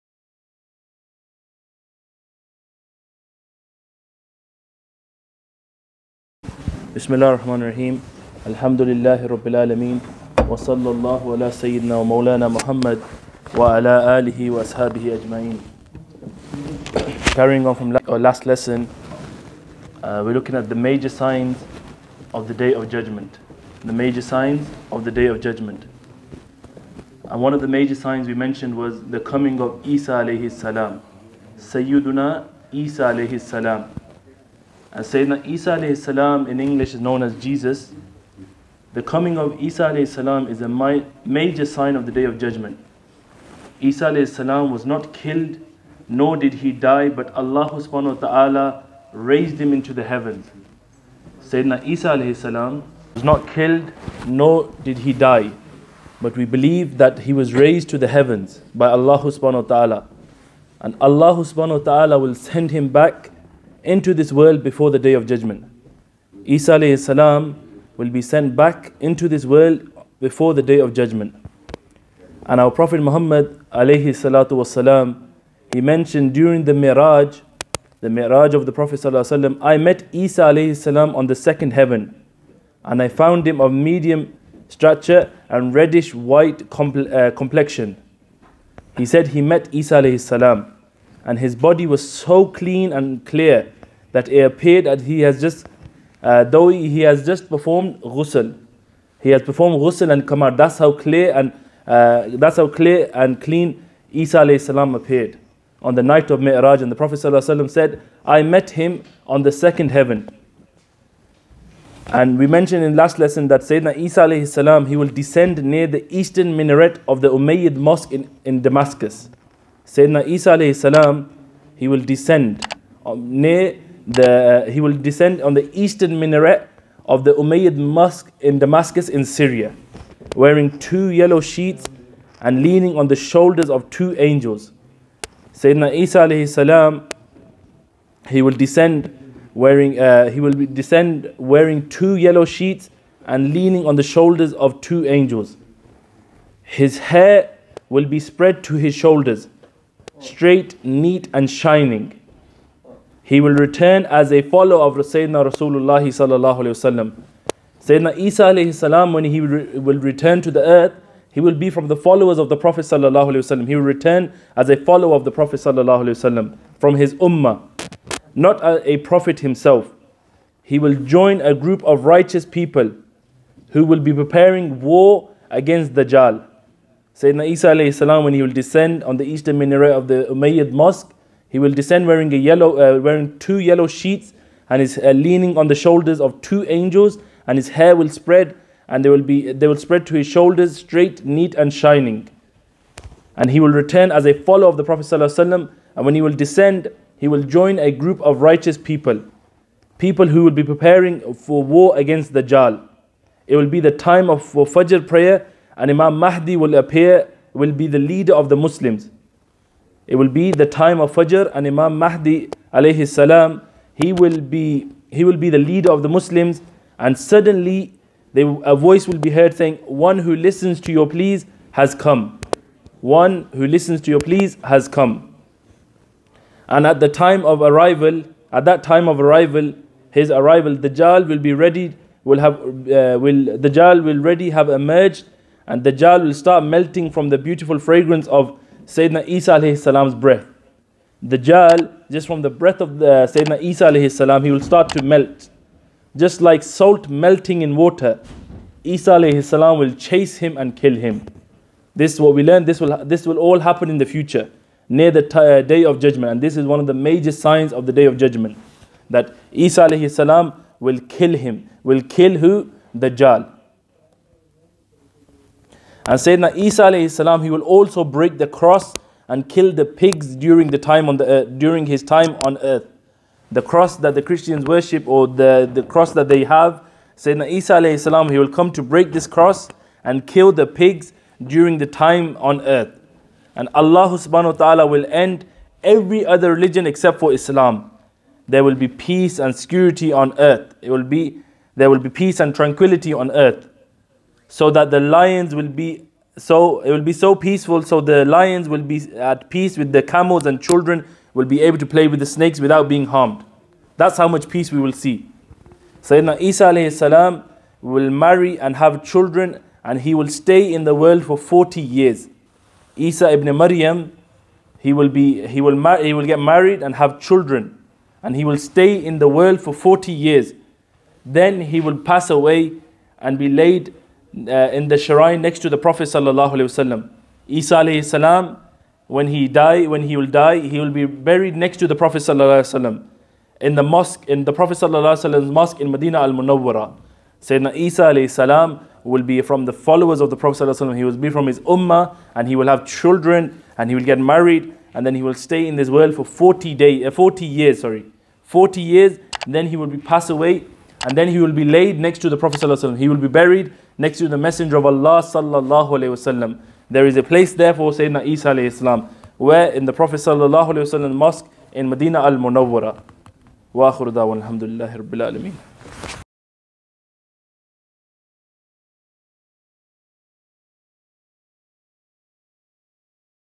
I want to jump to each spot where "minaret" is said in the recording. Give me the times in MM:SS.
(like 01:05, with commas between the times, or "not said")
01:56, 02:06, 02:59.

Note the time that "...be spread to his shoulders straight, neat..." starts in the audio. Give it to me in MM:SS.
02:28.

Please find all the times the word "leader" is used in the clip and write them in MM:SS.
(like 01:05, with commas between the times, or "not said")
03:27, 03:35.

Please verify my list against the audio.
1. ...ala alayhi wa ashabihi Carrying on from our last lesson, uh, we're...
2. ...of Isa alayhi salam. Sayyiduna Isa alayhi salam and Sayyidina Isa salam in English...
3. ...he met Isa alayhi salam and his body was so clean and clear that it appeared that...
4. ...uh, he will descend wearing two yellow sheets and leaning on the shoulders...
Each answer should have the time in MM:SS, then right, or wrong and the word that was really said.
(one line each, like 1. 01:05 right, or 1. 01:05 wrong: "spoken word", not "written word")
1. 00:13 wrong: "alihi", not "alayhi"
2. 00:29 right
3. 01:29 right
4. 02:19 right.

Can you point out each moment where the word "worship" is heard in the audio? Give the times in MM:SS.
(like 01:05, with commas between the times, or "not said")
04:34.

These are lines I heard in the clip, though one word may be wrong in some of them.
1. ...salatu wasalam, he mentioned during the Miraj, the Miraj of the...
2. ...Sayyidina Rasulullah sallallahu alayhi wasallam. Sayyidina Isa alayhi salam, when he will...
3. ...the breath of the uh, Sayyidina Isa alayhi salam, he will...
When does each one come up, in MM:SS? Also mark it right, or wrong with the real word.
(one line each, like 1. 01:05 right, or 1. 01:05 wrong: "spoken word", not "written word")
1. 01:14 right
2. 02:34 right
3. 04:02 right.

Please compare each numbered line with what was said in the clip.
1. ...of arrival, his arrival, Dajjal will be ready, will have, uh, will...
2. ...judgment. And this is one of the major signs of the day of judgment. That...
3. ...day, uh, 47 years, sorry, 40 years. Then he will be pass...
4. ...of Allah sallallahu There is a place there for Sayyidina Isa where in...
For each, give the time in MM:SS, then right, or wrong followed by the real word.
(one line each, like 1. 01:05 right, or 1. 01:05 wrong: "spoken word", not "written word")
1. 03:49 right
2. 04:16 right
3. 05:46 wrong: "40", not "47"
4. 05:54 right.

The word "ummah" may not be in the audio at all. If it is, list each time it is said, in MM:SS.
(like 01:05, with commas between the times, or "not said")
02:47, 05:41.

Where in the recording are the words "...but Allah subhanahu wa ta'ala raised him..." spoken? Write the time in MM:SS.
00:47.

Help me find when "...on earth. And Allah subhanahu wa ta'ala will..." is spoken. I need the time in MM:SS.
04:42.